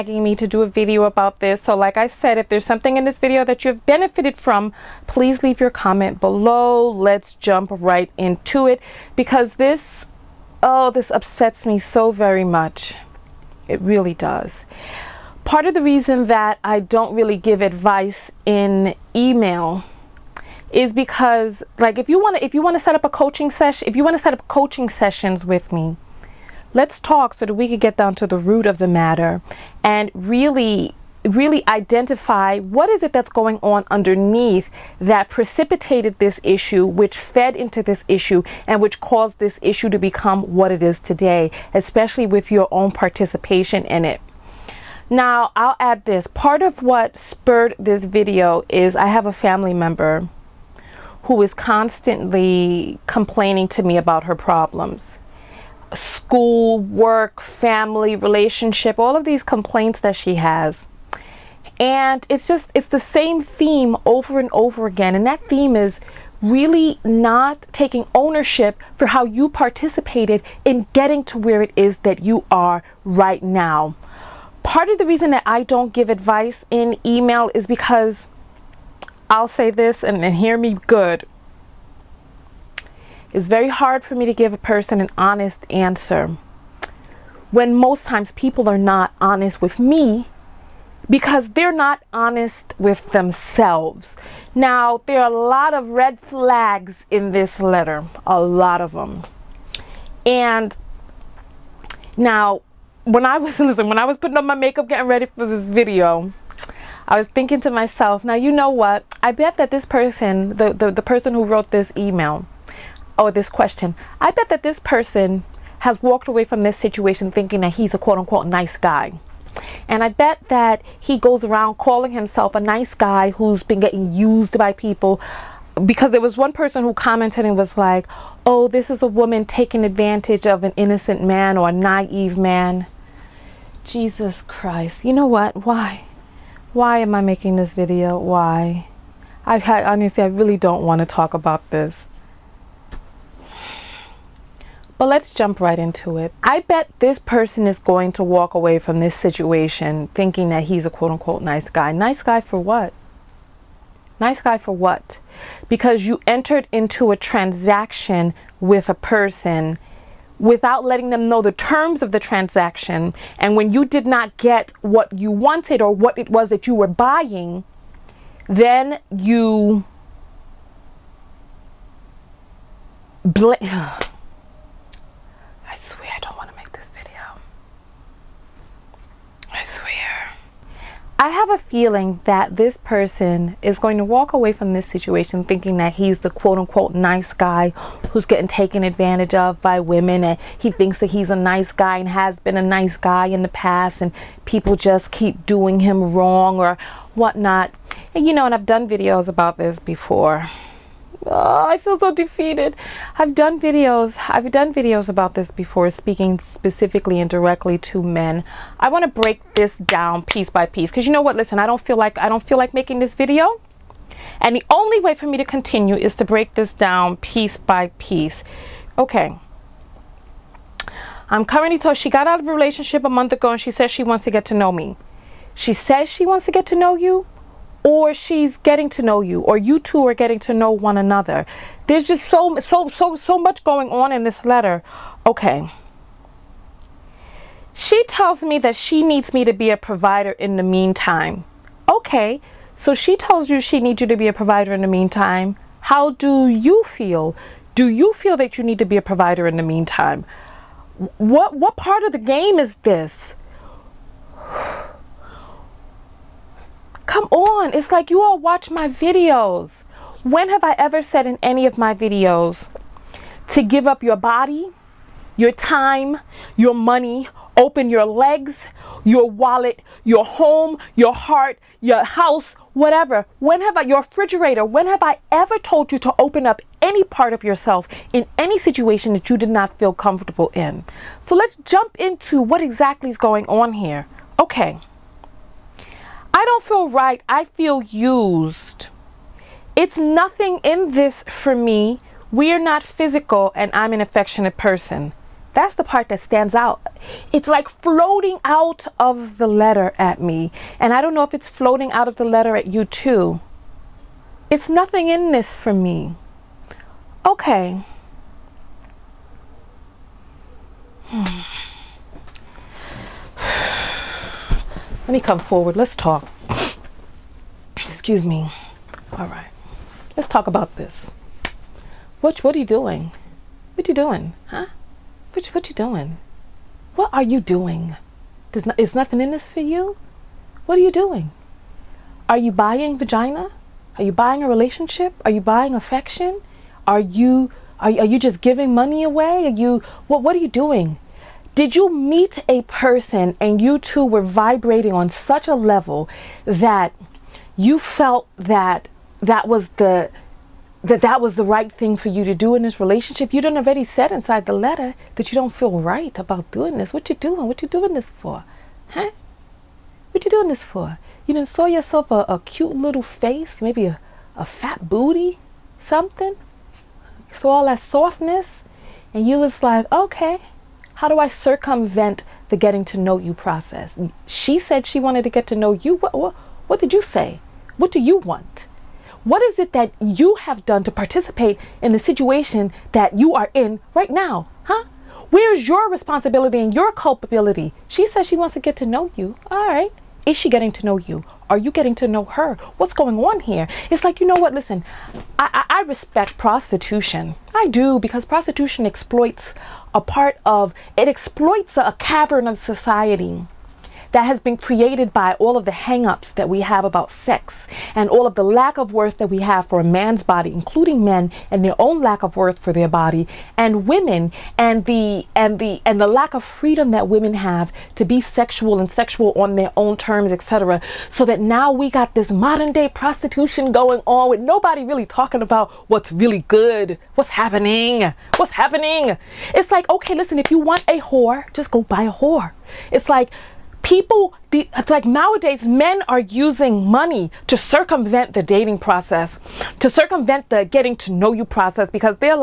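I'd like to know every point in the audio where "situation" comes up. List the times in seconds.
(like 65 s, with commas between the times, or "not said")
116 s, 149 s, 184 s, 278 s, 381 s.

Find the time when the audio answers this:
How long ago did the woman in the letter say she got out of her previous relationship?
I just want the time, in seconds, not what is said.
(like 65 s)
223 s.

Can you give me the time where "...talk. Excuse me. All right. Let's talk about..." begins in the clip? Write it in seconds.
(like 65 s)
315 s.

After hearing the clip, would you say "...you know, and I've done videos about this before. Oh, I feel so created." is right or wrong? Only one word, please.
wrong.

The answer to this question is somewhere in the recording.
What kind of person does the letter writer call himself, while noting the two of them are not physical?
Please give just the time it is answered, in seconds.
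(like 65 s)
293 s.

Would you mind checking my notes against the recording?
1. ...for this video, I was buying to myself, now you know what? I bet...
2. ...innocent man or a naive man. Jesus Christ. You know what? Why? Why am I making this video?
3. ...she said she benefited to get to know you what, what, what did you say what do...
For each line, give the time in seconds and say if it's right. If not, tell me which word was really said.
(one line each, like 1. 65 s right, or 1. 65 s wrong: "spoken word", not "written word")
1. 105 s wrong: "thinking", not "buying"
2. 130 s right
3. 374 s wrong: "wanted", not "benefited".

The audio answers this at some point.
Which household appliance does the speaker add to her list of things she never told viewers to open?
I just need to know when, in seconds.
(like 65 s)
274 s.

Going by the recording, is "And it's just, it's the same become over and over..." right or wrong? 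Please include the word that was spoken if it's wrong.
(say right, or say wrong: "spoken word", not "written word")
wrong: "theme", not "become".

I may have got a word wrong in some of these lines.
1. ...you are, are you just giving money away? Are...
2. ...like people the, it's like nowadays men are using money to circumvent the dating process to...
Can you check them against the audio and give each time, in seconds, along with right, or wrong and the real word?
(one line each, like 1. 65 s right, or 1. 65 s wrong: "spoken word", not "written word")
1. 336 s right
2. 433 s right.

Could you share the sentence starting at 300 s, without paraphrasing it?
And I don't know if it's floating out of the letter at you too.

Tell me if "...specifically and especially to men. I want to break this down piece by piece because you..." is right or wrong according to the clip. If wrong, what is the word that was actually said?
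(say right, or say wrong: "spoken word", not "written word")
wrong: "directly", not "especially".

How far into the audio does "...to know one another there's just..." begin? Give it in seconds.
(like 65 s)
230 s.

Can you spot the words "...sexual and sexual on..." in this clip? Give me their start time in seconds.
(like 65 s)
418 s.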